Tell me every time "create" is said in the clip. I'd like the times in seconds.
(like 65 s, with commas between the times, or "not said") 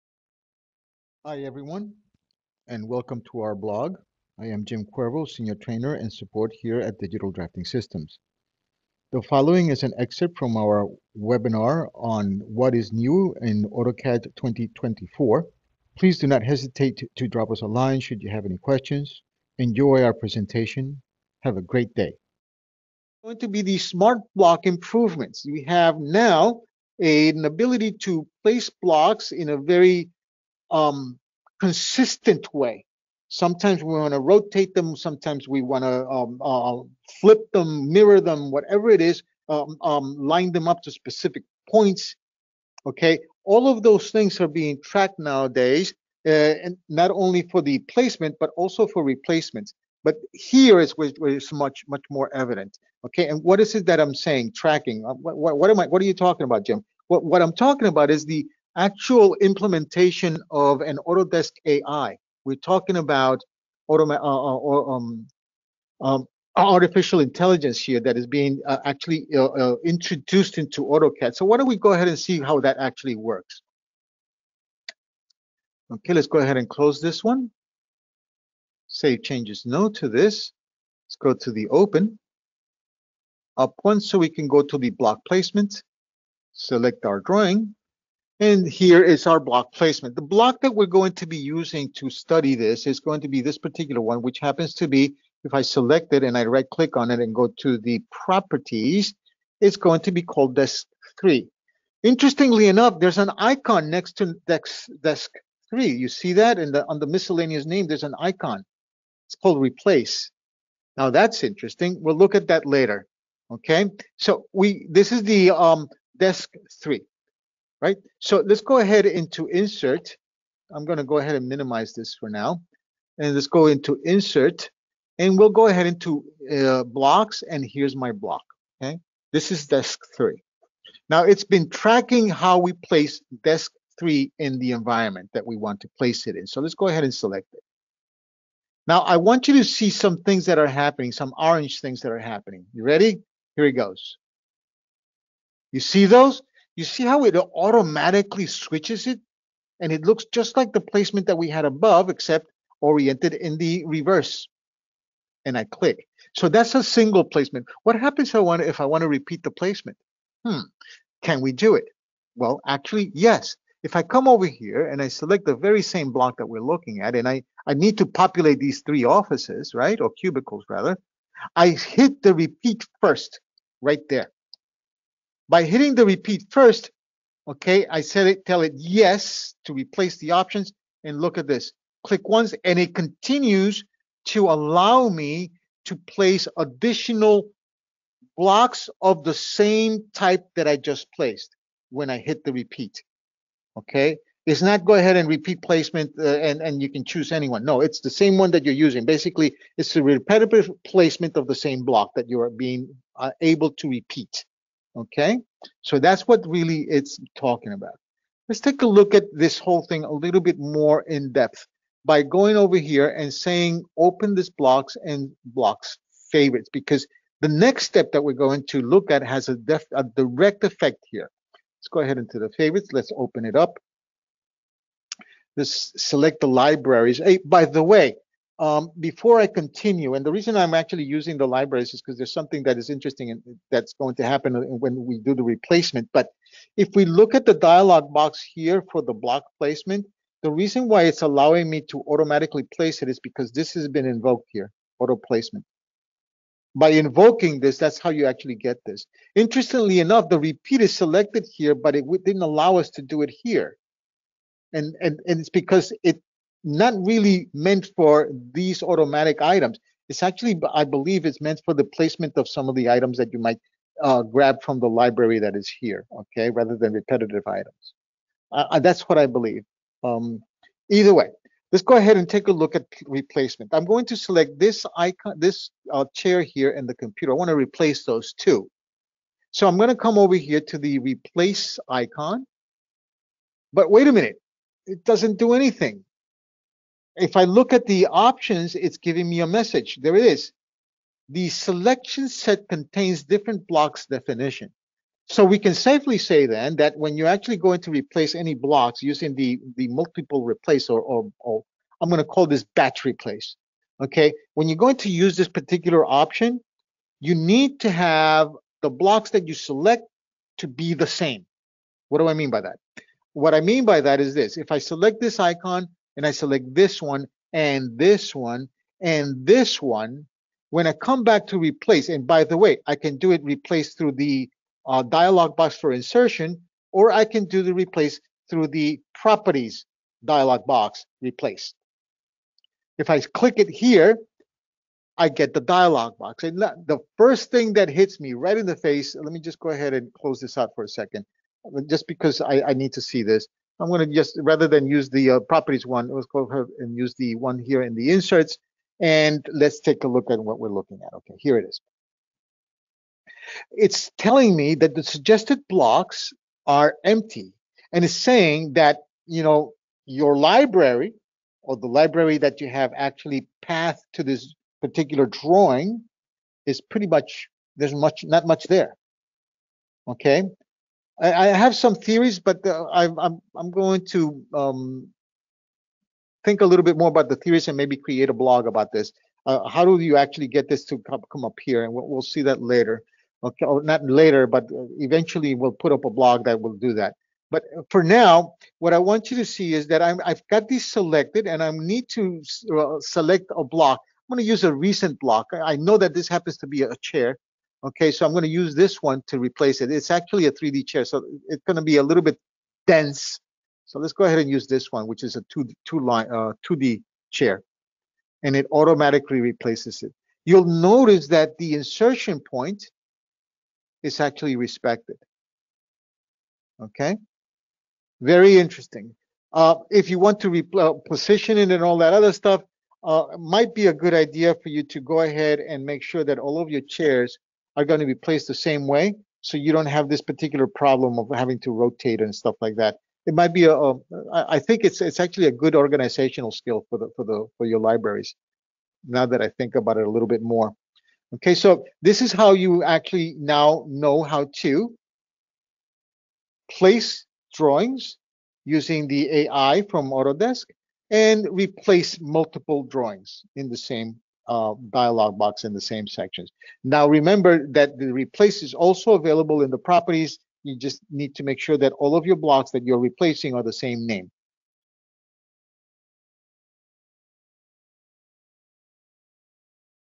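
377 s.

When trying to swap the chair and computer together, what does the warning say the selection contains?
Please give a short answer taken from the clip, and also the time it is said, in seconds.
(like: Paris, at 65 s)
different blocks definition, at 293 s.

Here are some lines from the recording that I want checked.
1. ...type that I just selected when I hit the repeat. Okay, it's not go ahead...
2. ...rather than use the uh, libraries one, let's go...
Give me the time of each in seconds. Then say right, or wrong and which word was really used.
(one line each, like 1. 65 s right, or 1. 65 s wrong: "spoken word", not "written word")
1. 190 s wrong: "placed", not "selected"
2. 344 s wrong: "properties", not "libraries".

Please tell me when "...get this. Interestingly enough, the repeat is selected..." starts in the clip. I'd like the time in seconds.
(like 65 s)
248 s.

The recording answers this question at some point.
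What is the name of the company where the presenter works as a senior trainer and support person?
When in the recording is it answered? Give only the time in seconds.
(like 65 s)
6 s.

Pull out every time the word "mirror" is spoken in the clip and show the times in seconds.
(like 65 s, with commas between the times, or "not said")
37 s.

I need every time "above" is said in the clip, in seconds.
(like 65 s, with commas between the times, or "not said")
151 s.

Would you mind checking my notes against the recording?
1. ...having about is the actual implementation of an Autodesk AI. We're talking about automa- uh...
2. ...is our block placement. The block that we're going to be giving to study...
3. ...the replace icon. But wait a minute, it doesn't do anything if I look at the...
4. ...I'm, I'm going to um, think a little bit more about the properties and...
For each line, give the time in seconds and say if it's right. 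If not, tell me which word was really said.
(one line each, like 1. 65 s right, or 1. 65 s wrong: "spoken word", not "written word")
1. 57 s wrong: "talking", not "having"
2. 89 s wrong: "using", not "giving"
3. 280 s right
4. 373 s wrong: "theories", not "properties".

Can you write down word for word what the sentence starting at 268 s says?
Uh, uh that's what I believe.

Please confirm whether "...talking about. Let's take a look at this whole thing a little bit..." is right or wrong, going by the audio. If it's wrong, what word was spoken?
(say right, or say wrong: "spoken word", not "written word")
right.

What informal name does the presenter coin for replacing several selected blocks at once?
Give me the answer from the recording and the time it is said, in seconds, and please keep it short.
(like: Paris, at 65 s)
batch replace, at 302 s.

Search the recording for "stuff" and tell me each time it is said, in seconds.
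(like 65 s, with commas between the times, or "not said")
422 s, 432 s.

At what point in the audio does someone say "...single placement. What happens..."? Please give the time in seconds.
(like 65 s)
156 s.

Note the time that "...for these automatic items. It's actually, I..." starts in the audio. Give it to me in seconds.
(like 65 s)
257 s.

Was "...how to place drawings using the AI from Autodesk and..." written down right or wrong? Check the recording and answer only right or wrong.
right.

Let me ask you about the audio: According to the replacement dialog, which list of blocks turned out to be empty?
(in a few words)
suggested blocks.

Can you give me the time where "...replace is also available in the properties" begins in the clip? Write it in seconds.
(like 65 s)
458 s.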